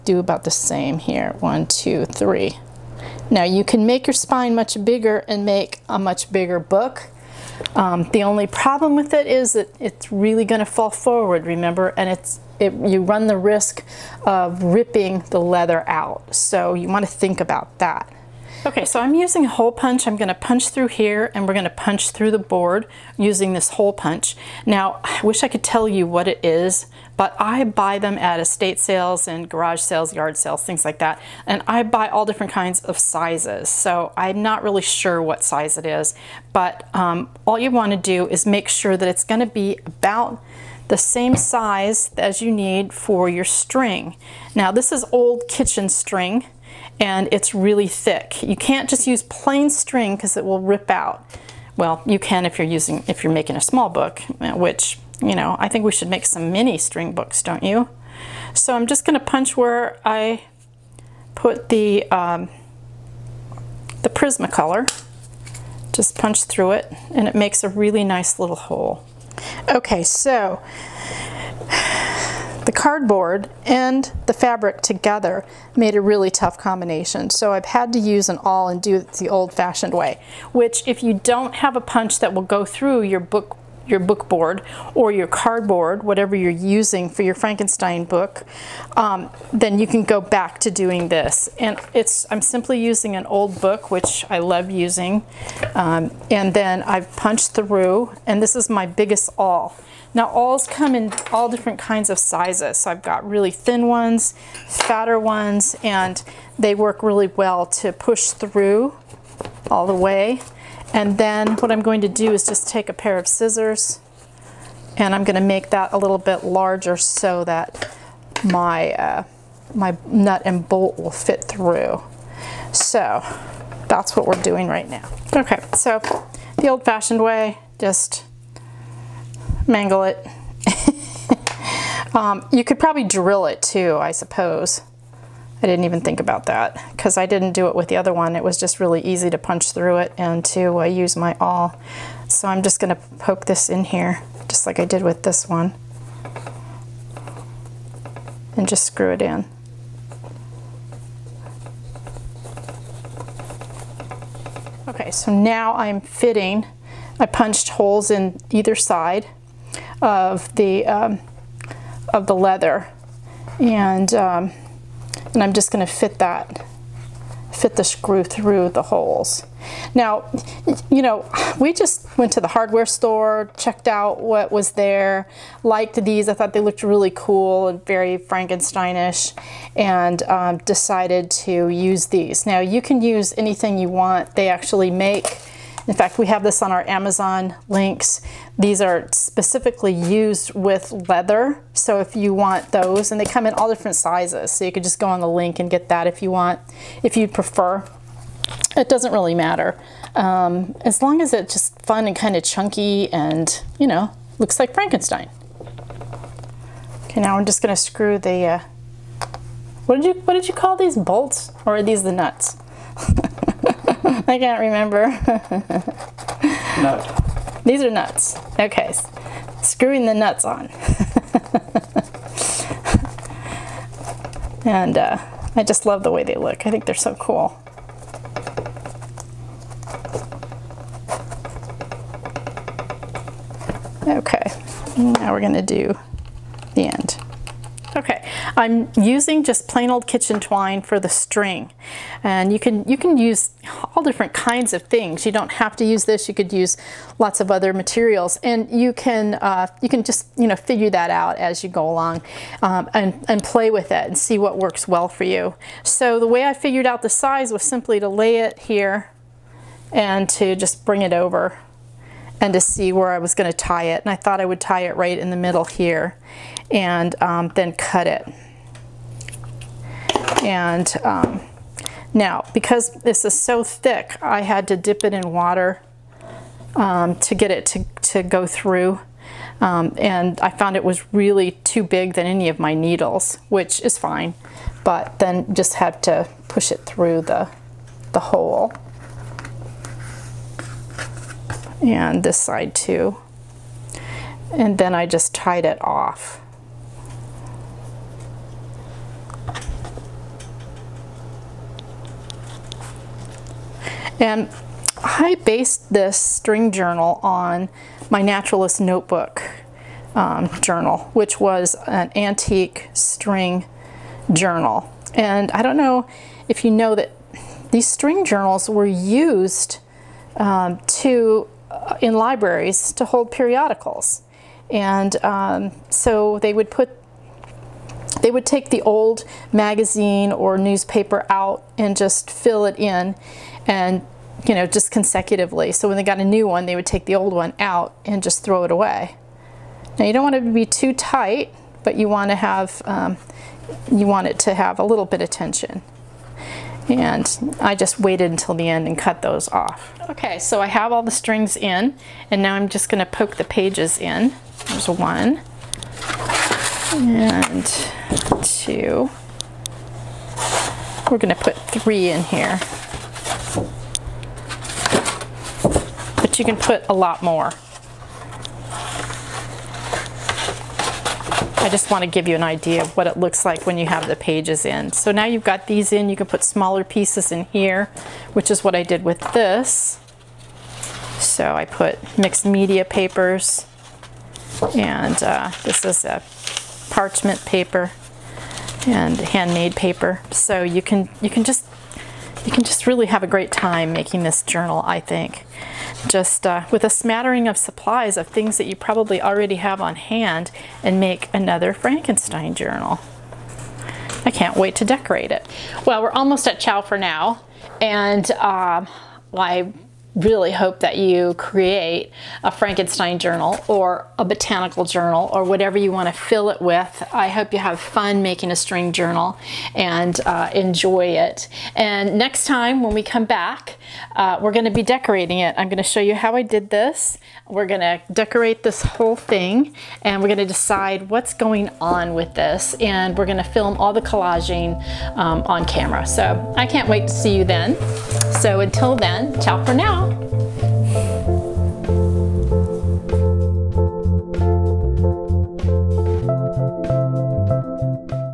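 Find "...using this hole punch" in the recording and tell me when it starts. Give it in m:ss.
0:23.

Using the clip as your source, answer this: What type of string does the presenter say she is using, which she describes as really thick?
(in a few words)
Old kitchen string.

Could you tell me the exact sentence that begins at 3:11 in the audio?
So if you want those, and they come in all different sizes.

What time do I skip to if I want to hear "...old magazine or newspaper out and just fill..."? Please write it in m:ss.
5:28.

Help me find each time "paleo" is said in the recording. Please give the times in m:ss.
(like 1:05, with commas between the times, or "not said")
not said.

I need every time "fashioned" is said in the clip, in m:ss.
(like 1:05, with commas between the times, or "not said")
1:19, 2:06.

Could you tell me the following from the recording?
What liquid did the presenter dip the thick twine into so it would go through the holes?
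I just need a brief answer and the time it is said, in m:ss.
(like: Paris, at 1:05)
Water, at 4:35.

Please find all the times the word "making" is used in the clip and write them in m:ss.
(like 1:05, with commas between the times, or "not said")
0:53, 6:33, 6:58.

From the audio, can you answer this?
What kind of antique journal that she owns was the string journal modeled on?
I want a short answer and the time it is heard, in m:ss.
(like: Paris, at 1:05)
Naturalist notebook, at 5:08.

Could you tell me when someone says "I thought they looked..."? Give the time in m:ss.
2:56.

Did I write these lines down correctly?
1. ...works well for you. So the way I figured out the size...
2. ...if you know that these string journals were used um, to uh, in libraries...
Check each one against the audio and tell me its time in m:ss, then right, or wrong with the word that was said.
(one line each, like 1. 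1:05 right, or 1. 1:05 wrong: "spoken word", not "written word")
1. 4:14 right
2. 5:16 right.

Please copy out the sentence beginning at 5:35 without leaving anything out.
So when they got a new one, they would take the old one out and just throw it away.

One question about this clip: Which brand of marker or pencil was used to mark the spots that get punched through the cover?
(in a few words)
Prismacolor.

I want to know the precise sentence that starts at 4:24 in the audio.
And I thought I would tie it right in the middle here and um, then cut it.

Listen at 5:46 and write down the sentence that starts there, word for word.
And I just waited until the end and cut those off.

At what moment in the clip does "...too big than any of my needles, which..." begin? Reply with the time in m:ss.
4:41.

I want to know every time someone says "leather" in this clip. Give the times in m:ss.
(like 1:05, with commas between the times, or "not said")
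0:15, 2:42, 3:11.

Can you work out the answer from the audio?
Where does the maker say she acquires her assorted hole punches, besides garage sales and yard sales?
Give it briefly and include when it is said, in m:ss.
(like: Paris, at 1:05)
Estate sales, at 0:28.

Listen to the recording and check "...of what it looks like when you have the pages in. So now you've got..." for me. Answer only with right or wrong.
right.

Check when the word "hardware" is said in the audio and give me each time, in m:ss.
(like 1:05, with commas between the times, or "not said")
2:52.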